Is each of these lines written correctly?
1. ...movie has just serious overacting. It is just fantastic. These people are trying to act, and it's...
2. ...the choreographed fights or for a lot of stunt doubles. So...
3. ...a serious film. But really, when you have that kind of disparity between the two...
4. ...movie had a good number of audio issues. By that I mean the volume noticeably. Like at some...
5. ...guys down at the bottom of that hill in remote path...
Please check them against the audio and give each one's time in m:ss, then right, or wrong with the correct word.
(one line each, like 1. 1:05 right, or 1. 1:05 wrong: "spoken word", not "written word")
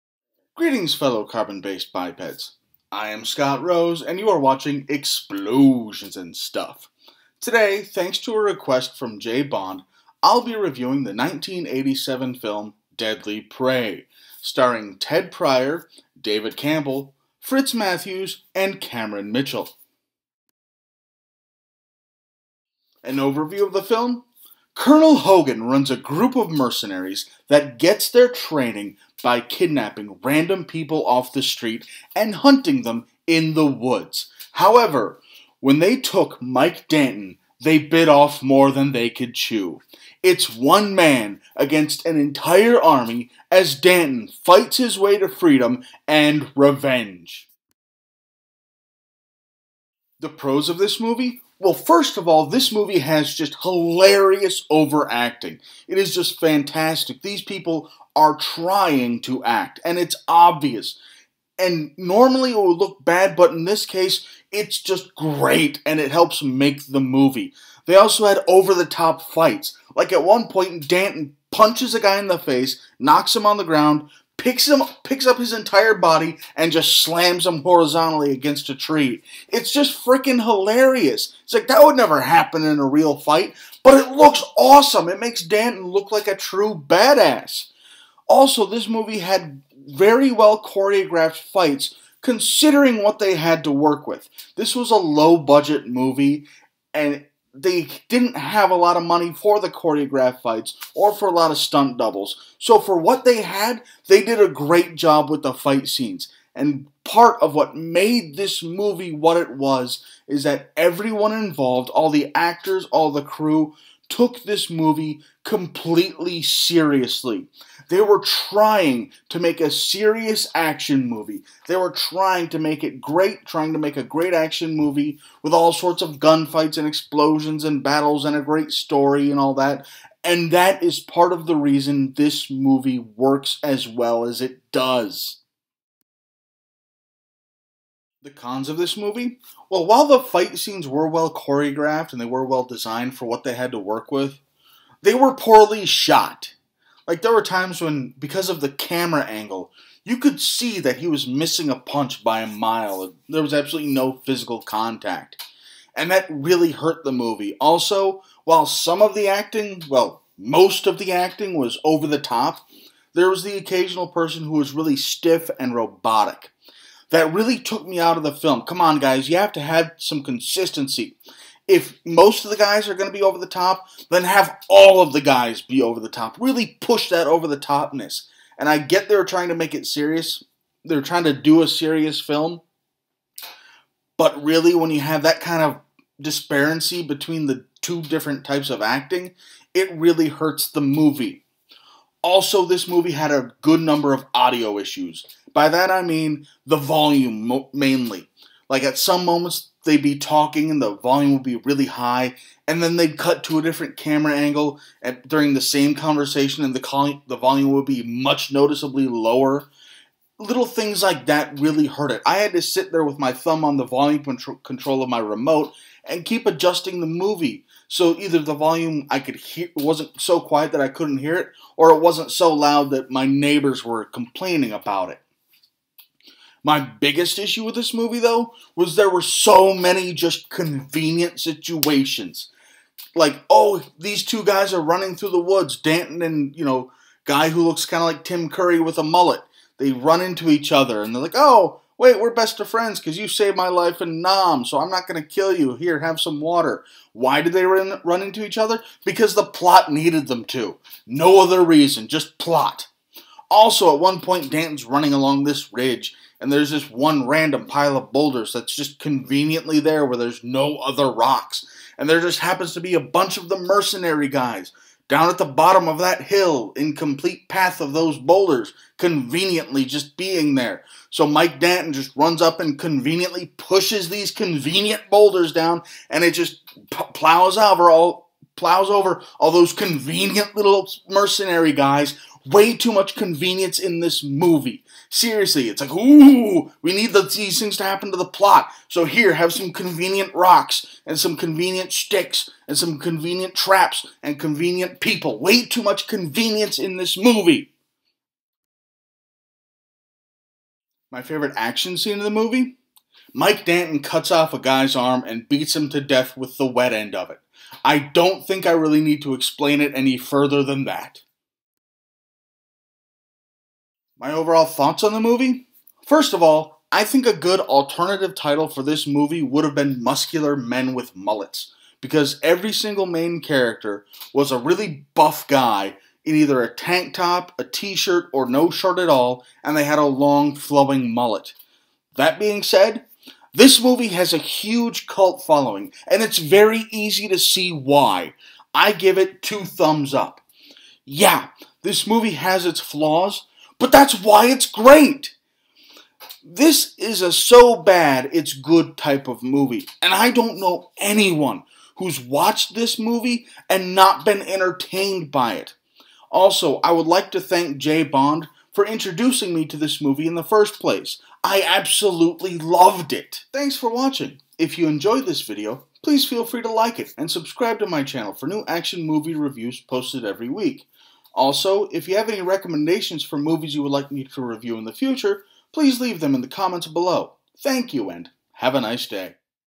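1. 0:52 wrong: "hilarious", not "serious"
2. 1:39 right
3. 3:01 right
4. 3:12 wrong: "mainly", not "noticeably"
5. 4:24 wrong: "complete", not "remote".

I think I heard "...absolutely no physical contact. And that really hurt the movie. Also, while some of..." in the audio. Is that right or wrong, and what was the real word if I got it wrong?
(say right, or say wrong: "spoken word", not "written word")
right.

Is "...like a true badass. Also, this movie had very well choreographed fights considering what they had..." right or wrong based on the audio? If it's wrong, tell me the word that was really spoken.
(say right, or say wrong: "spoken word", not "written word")
right.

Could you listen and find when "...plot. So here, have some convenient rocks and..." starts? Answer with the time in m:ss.
4:48.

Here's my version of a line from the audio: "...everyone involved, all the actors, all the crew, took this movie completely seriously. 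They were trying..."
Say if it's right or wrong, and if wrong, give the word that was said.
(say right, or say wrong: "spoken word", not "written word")
right.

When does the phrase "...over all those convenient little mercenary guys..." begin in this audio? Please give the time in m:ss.
4:38.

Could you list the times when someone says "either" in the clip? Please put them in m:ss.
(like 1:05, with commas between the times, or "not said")
3:38, 5:26.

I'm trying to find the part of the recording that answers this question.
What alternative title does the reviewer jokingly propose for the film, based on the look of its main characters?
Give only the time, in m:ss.
5:20.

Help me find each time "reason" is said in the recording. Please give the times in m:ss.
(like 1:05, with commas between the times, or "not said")
2:11, 4:11.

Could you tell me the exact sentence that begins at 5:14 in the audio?
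My overall thoughts on the movie?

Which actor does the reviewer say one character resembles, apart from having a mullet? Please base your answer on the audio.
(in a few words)
Tim Curry.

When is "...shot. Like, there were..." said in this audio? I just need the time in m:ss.
2:25.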